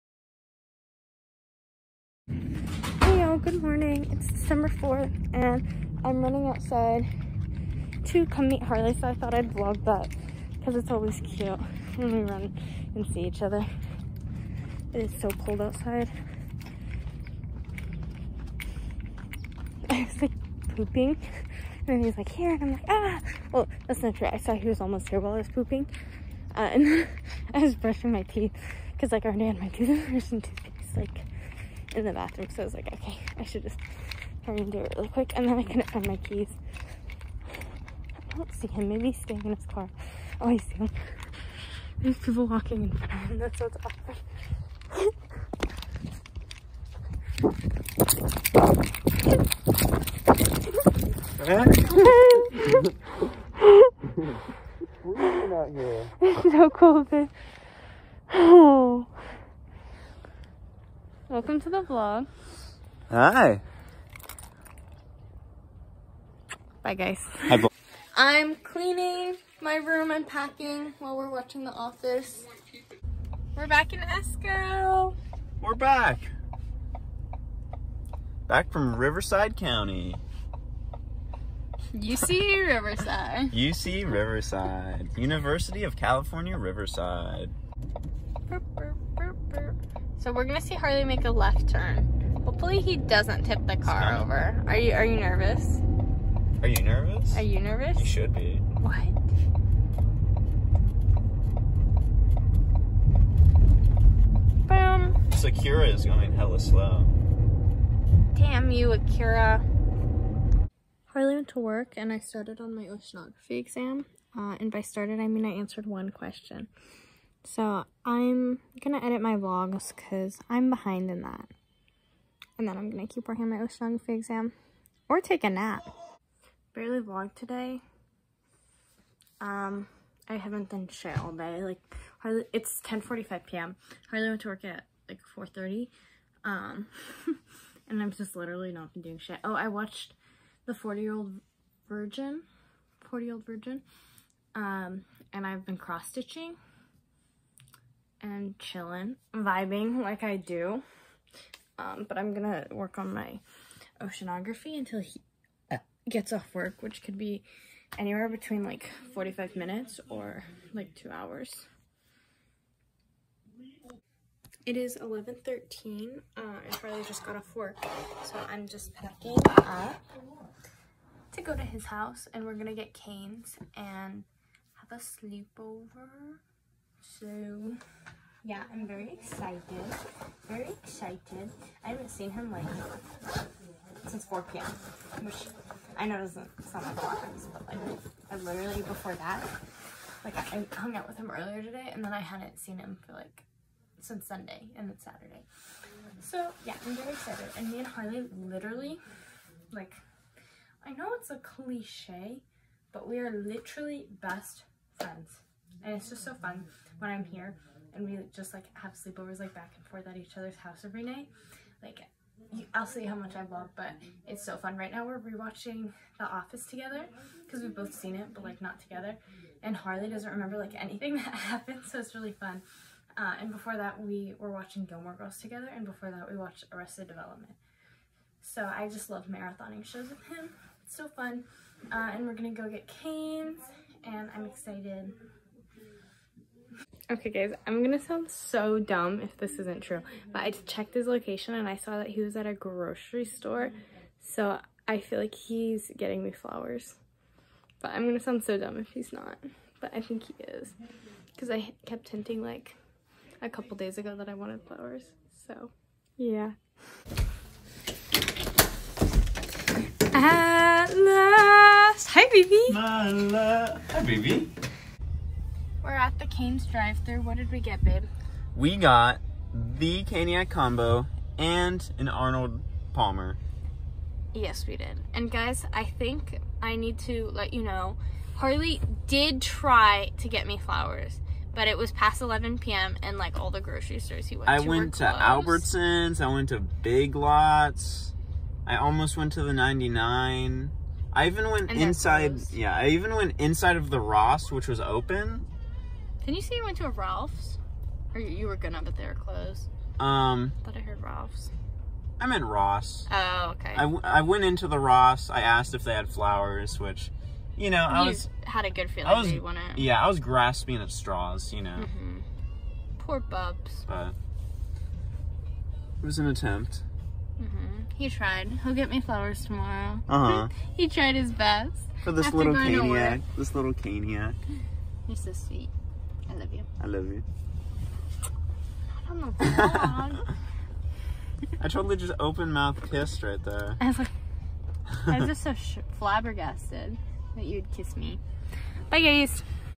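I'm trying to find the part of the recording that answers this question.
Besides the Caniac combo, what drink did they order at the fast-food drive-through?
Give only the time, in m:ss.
4:32.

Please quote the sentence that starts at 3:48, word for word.
So I just love marathoning shows with him.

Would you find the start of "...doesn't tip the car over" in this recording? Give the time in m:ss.
1:32.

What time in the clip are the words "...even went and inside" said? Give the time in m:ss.
4:51.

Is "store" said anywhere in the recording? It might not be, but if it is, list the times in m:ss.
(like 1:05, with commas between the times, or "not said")
4:03, 4:43.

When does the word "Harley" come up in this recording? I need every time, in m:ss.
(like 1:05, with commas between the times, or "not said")
0:08, 1:30, 1:51, 3:17, 3:39, 4:38.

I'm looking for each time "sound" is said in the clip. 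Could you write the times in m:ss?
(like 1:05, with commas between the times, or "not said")
3:06, 3:57, 4:08.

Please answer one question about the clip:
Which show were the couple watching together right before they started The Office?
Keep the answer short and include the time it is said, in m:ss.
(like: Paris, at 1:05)
Gilmore Girls, at 3:44.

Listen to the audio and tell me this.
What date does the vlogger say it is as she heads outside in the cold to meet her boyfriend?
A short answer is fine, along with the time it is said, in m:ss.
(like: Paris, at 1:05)
December 4th, at 0:04.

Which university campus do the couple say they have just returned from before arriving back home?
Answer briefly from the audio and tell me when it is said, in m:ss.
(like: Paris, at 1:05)
UC Riverside, at 1:25.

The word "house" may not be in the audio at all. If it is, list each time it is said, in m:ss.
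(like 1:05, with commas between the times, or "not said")
2:51, 3:30.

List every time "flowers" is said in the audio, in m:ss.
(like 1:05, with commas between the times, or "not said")
4:06, 4:14, 4:40, 5:06, 5:19.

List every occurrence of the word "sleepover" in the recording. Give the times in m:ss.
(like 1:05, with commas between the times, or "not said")
2:55, 3:28.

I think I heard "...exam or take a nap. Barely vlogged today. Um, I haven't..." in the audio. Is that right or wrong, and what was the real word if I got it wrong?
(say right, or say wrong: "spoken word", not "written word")
right.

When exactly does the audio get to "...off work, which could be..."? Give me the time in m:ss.
2:36.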